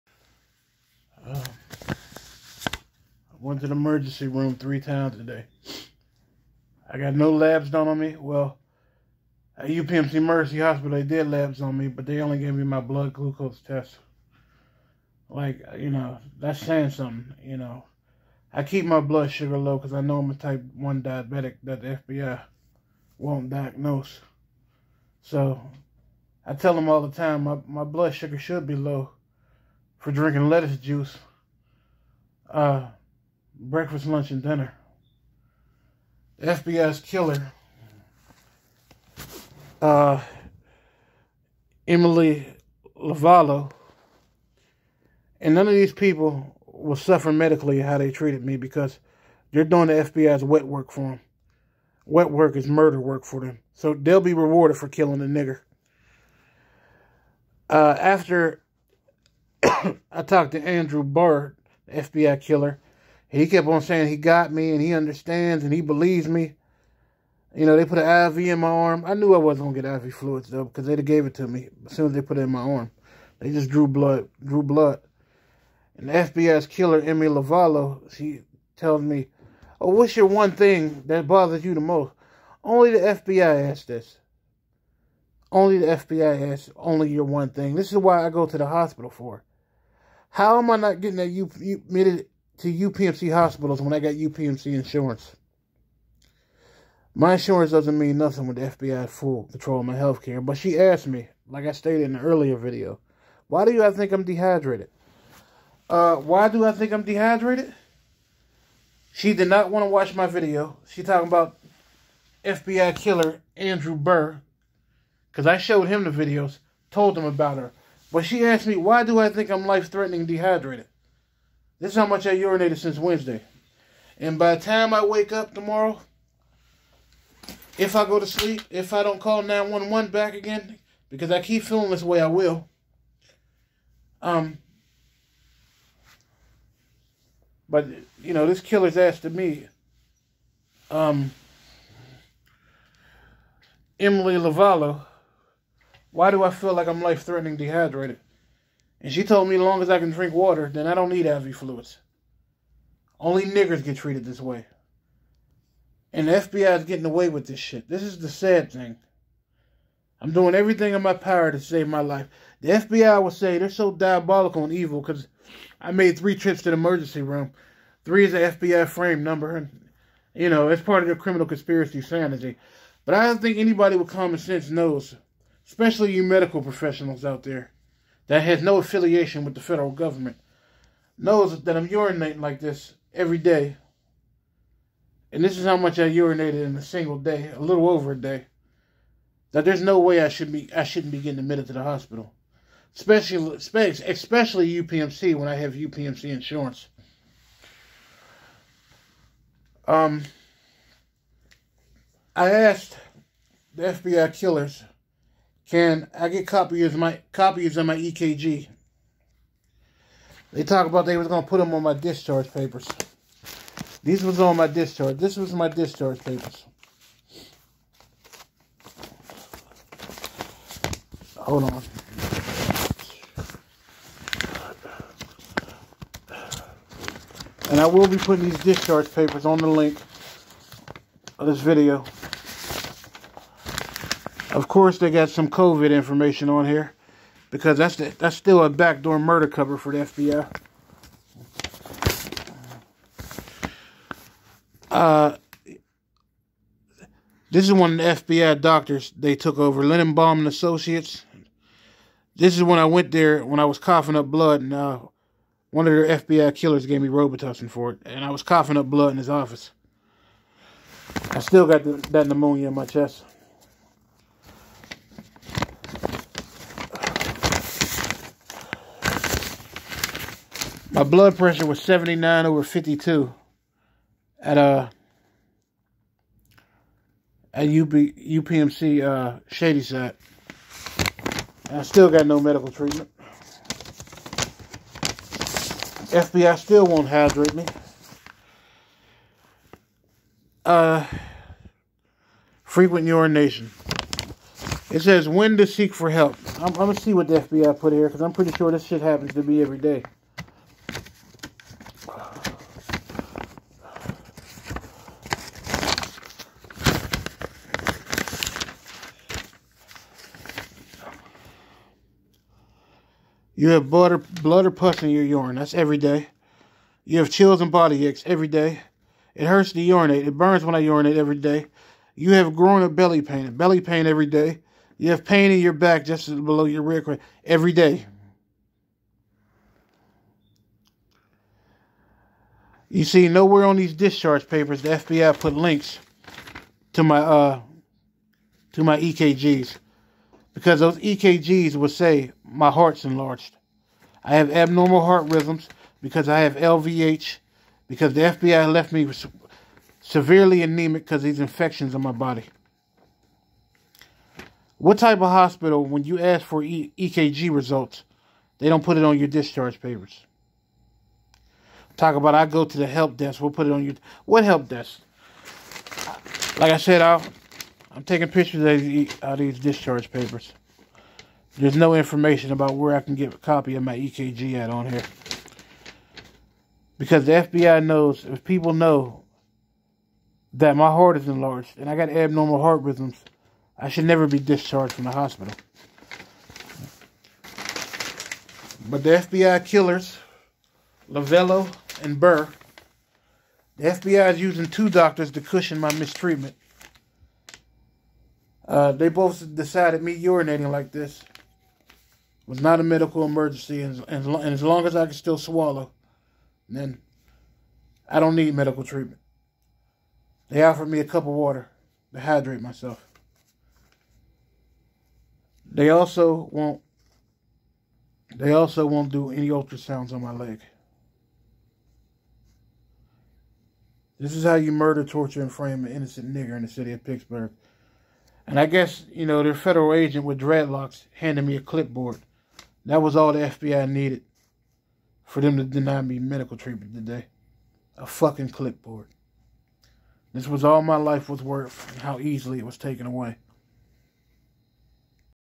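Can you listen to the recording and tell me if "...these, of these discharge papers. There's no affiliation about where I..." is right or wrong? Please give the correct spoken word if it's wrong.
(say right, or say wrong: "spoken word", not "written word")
wrong: "information", not "affiliation".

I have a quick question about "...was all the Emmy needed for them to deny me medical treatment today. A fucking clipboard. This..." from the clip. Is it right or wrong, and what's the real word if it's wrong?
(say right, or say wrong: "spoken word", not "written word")
wrong: "FBI", not "Emmy".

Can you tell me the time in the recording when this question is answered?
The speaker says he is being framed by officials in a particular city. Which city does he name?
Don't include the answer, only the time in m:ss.
7:07.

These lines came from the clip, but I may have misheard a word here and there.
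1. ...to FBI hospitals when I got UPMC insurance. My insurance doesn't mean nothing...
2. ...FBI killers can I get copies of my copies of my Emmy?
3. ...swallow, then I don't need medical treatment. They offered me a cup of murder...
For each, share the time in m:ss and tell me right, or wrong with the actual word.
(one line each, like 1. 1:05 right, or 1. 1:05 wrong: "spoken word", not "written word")
1. 1:32 wrong: "UPMC", not "FBI"
2. 3:23 wrong: "EKG", not "Emmy"
3. 6:45 wrong: "water", not "murder".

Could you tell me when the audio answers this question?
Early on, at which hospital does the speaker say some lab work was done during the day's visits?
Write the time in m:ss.
0:09.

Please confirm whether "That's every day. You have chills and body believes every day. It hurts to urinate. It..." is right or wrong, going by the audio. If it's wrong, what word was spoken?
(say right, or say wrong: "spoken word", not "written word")
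wrong: "aches", not "believes".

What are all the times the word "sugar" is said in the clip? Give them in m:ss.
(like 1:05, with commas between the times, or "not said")
0:19, 0:28.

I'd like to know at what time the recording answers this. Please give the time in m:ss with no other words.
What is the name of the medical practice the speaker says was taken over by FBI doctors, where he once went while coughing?
4:09.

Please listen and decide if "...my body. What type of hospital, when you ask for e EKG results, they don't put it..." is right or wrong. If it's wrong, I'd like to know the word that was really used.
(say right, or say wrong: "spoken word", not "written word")
right.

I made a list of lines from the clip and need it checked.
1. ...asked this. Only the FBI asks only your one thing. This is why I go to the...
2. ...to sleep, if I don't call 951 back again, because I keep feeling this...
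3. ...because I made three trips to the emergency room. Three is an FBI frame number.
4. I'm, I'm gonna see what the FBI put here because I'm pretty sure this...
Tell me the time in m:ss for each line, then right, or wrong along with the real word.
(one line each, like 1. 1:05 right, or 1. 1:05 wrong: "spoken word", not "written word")
1. 1:23 right
2. 2:08 wrong: "911", not "951"
3. 2:45 right
4. 4:56 right.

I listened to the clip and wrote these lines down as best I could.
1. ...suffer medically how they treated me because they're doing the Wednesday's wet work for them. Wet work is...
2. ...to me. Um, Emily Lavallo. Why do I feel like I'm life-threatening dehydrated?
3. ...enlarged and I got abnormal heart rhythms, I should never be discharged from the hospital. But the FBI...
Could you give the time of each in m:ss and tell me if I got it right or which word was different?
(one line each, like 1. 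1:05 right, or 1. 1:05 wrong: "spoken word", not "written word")
1. 0:46 wrong: "FBI", not "Wednesday"
2. 2:19 right
3. 6:21 right.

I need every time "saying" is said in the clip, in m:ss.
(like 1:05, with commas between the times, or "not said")
0:16, 1:03.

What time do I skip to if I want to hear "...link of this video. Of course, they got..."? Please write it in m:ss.
3:49.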